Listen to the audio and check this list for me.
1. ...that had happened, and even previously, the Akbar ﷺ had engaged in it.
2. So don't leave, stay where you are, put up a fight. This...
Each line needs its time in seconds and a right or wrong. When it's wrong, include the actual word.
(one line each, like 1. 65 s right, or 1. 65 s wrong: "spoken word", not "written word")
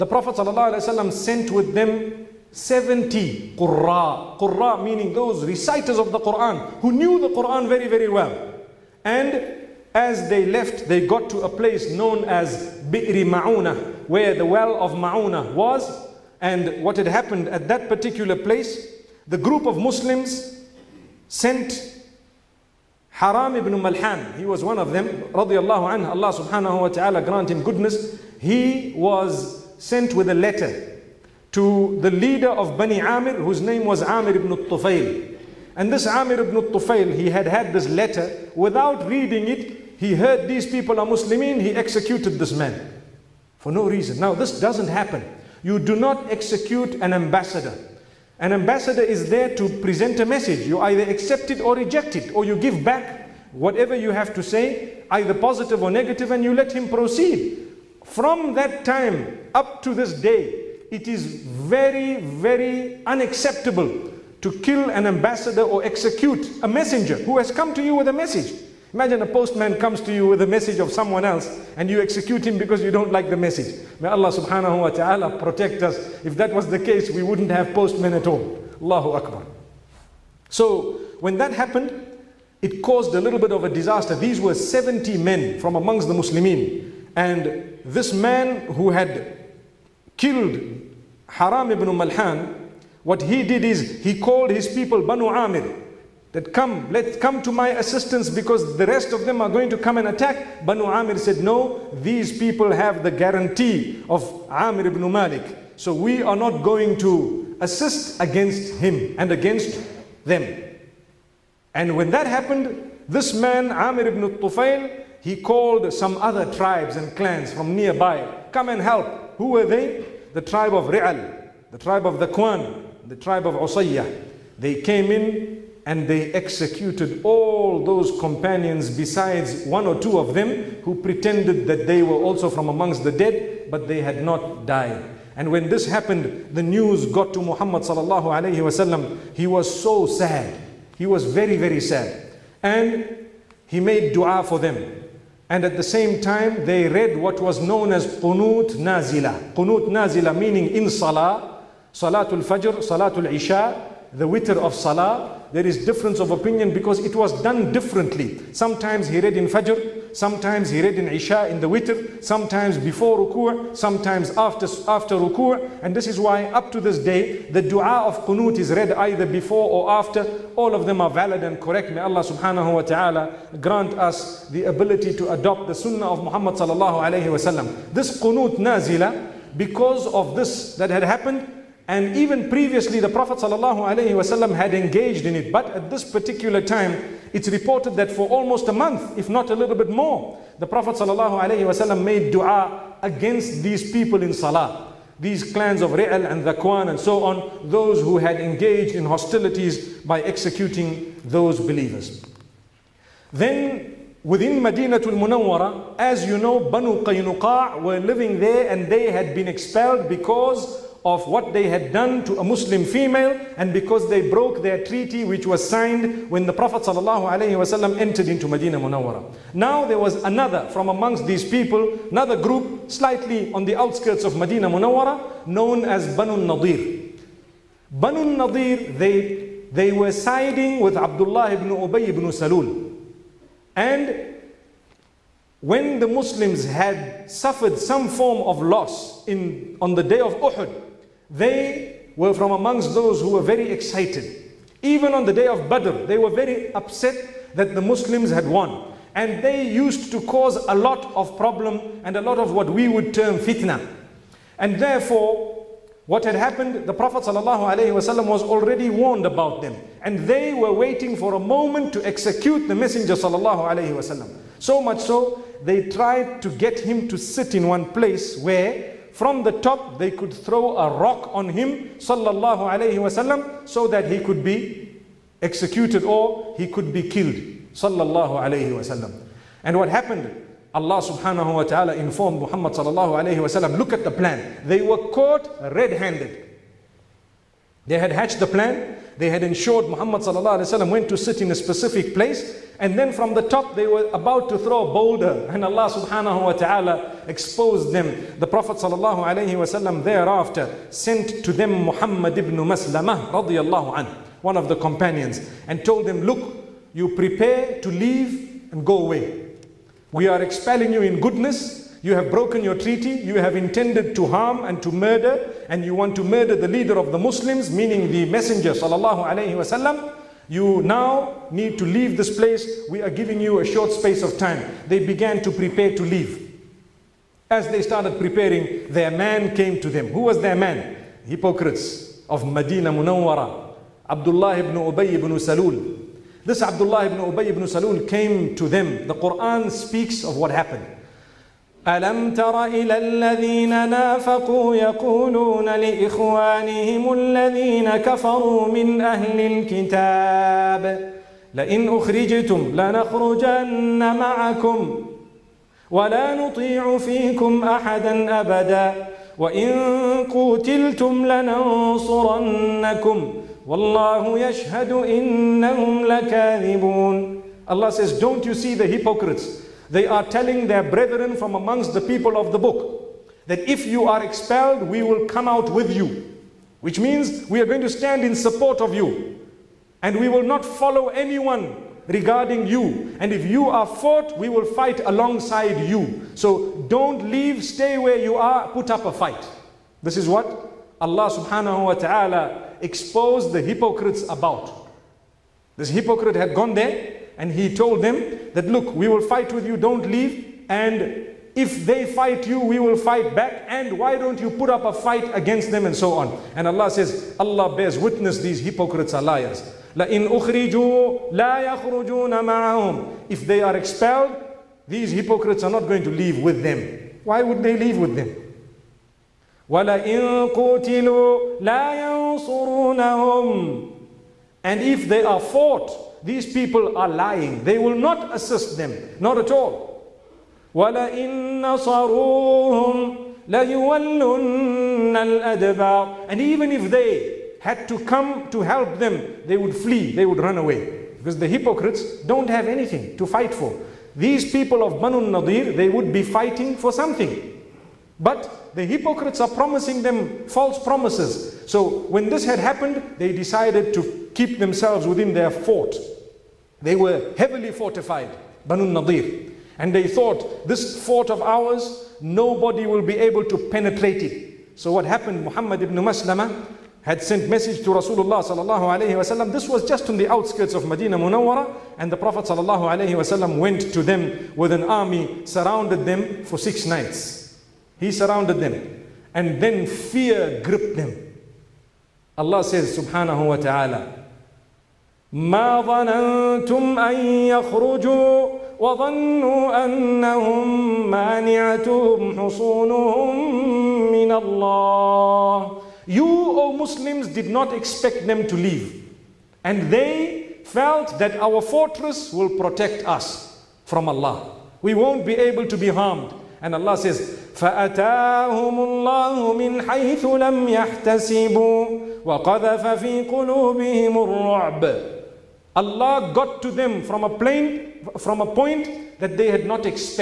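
1. 180 s wrong: "Prophet", not "Akbar"
2. 386 s right.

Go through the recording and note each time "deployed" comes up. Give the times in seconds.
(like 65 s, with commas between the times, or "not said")
not said.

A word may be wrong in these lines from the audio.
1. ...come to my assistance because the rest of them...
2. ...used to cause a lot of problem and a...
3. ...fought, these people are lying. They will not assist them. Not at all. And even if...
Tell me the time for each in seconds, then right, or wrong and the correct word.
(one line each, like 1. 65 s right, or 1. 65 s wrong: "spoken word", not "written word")
1. 97 s right
2. 249 s right
3. 425 s right.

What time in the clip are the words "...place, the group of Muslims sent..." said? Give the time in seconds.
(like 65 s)
18 s.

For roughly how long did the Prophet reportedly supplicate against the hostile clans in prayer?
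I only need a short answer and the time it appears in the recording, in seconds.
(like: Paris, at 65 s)
a month, at 188 s.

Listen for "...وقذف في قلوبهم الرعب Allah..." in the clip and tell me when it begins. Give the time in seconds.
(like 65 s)
512 s.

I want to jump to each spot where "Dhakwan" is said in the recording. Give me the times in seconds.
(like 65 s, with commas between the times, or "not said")
122 s, 196 s.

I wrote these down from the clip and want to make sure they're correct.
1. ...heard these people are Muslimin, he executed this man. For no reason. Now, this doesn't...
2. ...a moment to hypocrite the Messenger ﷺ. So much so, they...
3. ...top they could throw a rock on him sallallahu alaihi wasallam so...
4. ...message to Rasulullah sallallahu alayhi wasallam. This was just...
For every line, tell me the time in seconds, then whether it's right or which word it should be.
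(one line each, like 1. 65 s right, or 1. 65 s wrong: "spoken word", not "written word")
1. 40 s right
2. 261 s wrong: "execute", not "hypocrite"
3. 269 s right
4. 467 s right.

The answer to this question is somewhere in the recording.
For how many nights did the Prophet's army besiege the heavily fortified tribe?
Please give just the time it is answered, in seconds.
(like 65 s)
476 s.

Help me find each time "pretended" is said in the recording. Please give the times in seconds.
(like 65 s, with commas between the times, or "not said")
130 s.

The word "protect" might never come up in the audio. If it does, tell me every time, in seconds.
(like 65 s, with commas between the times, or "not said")
75 s, 502 s.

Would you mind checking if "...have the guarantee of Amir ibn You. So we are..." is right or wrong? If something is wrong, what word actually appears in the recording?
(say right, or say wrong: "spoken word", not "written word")
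wrong: "Malik", not "You".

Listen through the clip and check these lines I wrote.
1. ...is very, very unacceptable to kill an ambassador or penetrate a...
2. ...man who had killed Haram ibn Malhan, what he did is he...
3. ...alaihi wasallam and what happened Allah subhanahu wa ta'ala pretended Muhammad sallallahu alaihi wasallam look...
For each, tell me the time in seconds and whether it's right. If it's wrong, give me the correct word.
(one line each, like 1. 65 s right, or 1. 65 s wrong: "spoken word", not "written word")
1. 61 s wrong: "execute", not "penetrate"
2. 88 s right
3. 278 s wrong: "informed", not "pretended".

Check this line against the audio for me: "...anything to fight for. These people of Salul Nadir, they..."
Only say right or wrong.
wrong.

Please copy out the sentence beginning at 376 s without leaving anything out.
Which means we are going to stand in support of you.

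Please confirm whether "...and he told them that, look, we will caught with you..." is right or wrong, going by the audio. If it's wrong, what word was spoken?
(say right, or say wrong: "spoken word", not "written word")
wrong: "fight", not "caught".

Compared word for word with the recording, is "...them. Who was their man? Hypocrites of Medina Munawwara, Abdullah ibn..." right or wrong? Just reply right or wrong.
right.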